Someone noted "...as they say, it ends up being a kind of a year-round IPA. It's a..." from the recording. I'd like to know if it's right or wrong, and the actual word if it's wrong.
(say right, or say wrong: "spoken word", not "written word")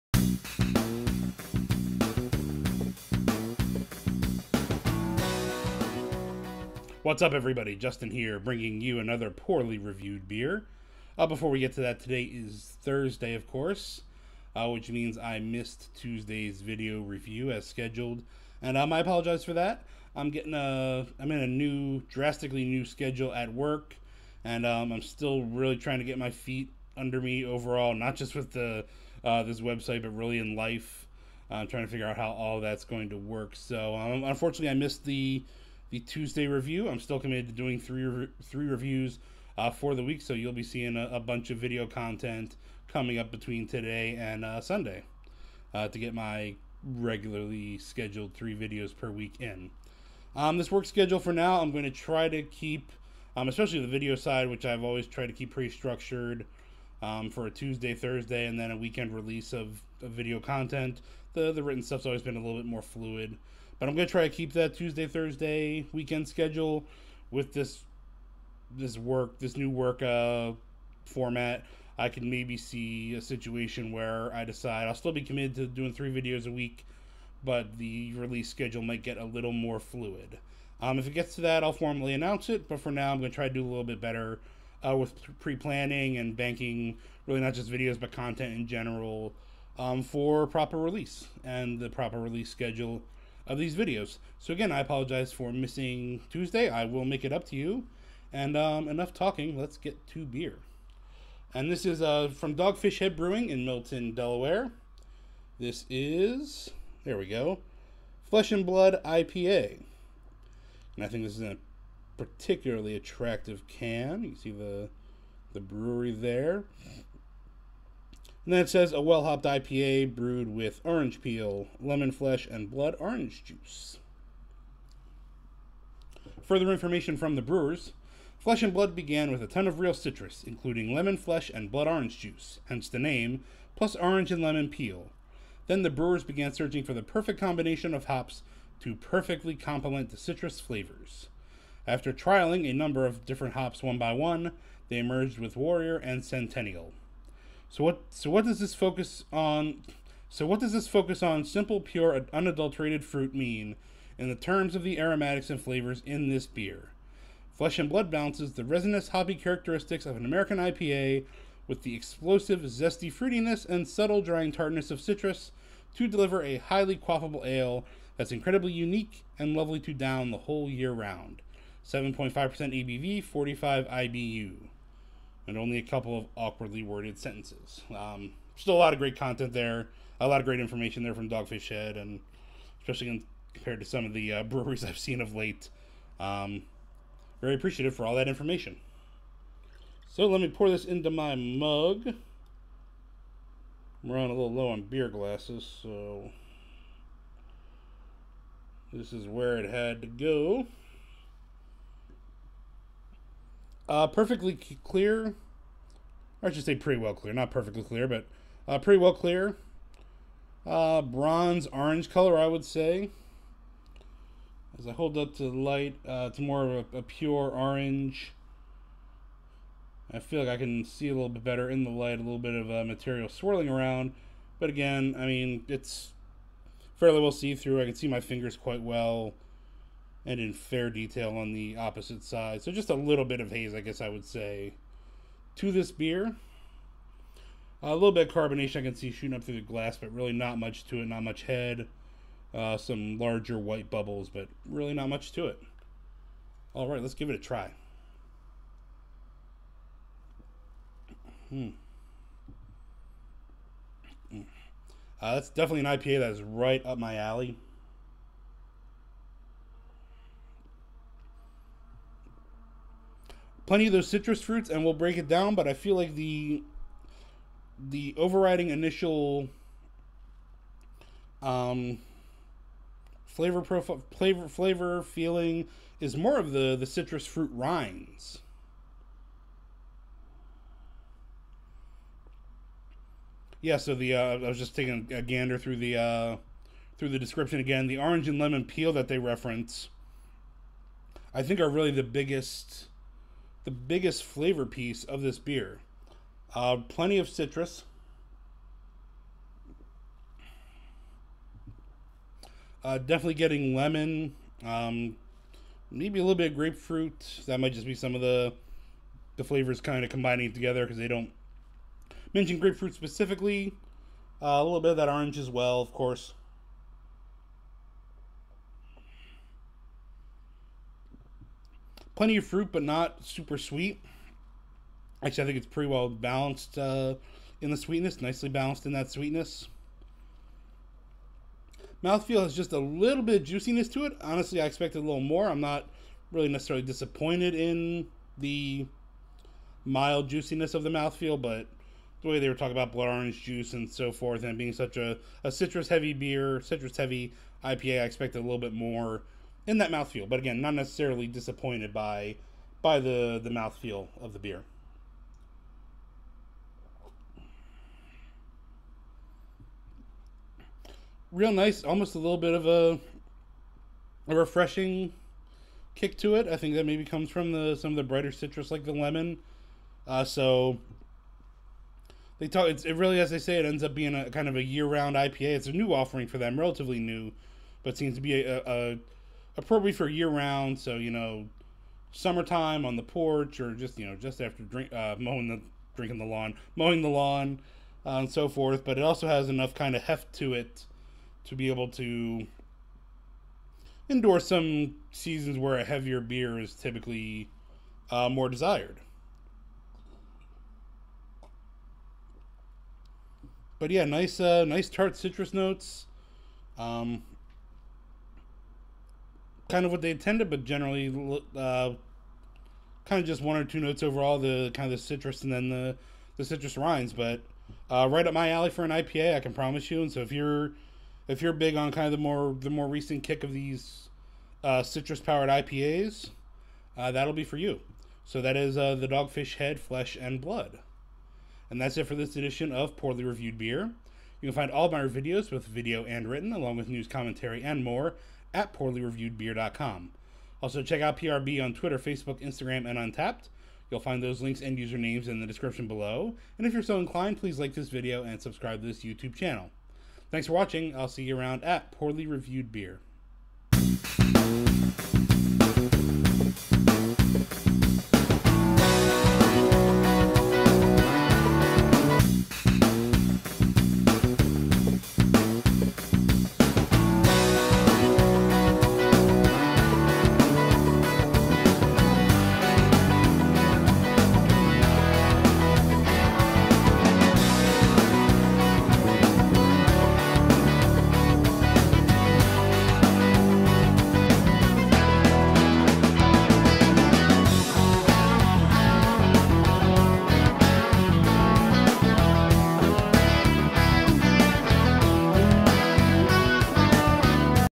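right.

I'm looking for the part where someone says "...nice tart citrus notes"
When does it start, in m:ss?
6:44.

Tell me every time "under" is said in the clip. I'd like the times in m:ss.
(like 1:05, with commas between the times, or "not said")
0:26.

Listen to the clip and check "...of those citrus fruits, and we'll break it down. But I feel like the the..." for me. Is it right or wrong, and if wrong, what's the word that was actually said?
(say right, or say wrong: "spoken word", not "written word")
right.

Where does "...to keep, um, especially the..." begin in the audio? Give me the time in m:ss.
0:52.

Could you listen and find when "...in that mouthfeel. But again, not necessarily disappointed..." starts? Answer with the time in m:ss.
5:49.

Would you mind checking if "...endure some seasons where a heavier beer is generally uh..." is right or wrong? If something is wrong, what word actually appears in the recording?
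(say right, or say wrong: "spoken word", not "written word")
wrong: "typically", not "generally".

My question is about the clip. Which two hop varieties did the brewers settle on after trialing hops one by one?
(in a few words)
Warrior and Centennial.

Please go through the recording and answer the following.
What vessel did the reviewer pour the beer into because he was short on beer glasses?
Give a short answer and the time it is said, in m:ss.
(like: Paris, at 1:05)
mug, at 3:11.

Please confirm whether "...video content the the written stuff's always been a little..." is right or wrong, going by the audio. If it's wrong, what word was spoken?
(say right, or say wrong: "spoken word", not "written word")
right.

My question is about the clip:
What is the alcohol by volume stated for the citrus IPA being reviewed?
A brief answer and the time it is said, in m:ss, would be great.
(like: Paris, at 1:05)
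7.5%, at 2:51.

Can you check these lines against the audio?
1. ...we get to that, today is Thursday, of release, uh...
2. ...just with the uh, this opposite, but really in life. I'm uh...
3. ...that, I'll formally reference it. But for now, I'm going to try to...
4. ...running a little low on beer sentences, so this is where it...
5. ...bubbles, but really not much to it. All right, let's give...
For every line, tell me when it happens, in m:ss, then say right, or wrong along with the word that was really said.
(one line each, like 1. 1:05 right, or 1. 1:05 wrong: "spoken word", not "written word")
1. 0:11 wrong: "course", not "release"
2. 0:28 wrong: "website", not "opposite"
3. 1:21 wrong: "announce", not "reference"
4. 3:14 wrong: "glasses", not "sentences"
5. 4:03 right.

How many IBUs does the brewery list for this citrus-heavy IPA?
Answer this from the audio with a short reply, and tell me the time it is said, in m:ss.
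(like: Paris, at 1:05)
45, at 2:53.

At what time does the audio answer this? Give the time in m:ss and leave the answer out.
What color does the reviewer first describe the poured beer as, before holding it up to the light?
3:31.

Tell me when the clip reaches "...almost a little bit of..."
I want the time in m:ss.
6:01.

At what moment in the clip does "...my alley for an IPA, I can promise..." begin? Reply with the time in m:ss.
6:58.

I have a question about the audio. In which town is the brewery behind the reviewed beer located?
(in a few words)
Milton, Delaware.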